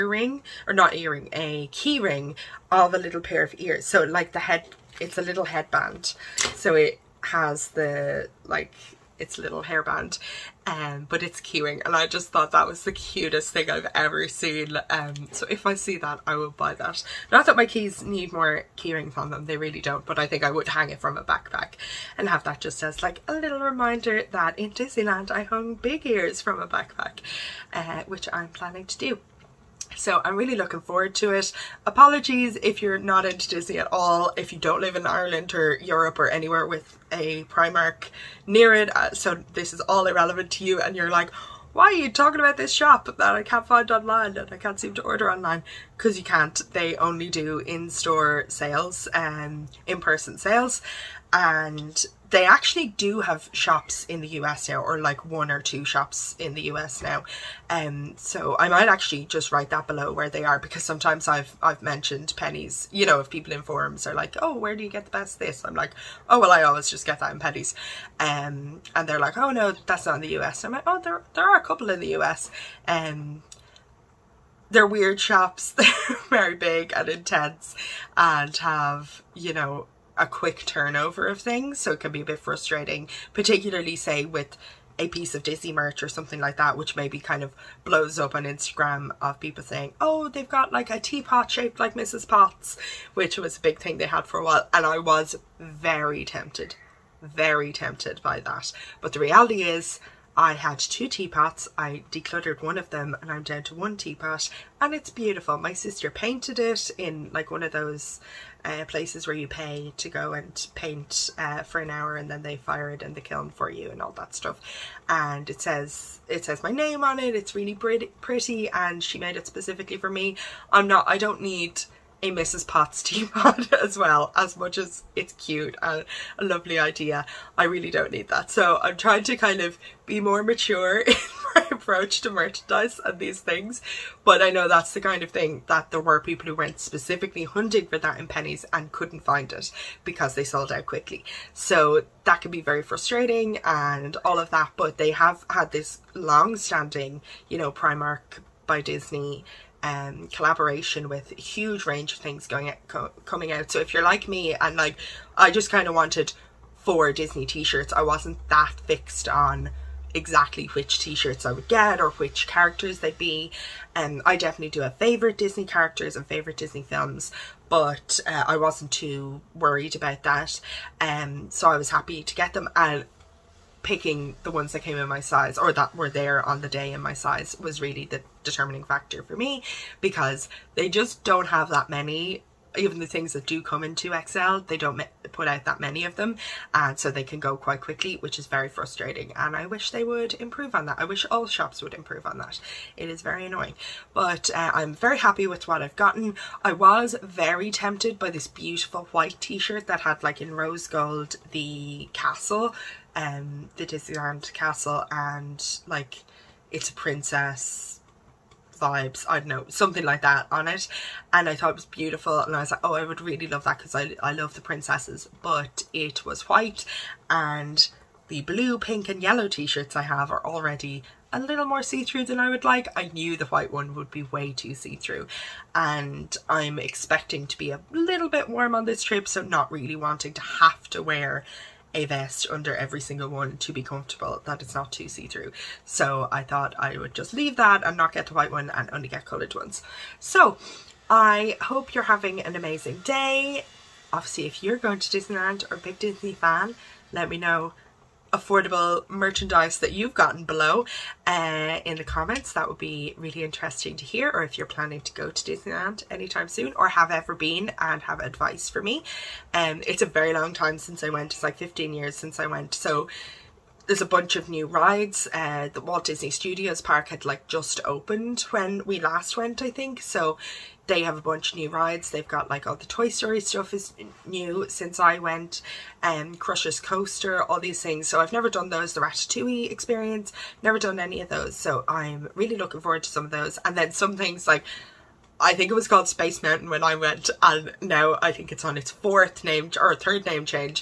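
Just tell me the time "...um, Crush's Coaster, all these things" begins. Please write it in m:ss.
4:36.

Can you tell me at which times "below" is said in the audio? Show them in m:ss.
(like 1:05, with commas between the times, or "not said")
0:59, 4:10.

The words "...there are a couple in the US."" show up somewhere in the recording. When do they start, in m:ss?
1:11.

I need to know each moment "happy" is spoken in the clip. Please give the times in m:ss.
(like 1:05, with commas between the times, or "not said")
2:51, 3:15.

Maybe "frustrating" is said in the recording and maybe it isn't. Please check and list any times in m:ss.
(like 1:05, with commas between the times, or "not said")
1:22, 2:22, 3:08.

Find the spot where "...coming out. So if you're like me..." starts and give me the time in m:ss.
2:33.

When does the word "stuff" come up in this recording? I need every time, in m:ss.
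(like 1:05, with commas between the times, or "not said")
1:54, 4:33.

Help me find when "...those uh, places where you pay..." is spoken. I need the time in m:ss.
1:47.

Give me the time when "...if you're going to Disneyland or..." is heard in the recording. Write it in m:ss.
4:04.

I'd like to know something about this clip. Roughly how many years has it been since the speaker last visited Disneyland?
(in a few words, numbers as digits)
15.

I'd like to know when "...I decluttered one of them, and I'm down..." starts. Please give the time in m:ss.
1:41.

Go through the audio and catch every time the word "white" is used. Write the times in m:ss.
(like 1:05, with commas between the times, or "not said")
3:19, 3:36, 3:43, 3:58.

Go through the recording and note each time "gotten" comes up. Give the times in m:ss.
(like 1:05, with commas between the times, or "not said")
3:15, 4:10.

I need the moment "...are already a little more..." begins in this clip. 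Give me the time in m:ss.
3:40.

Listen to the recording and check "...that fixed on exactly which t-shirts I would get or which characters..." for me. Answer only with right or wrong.
right.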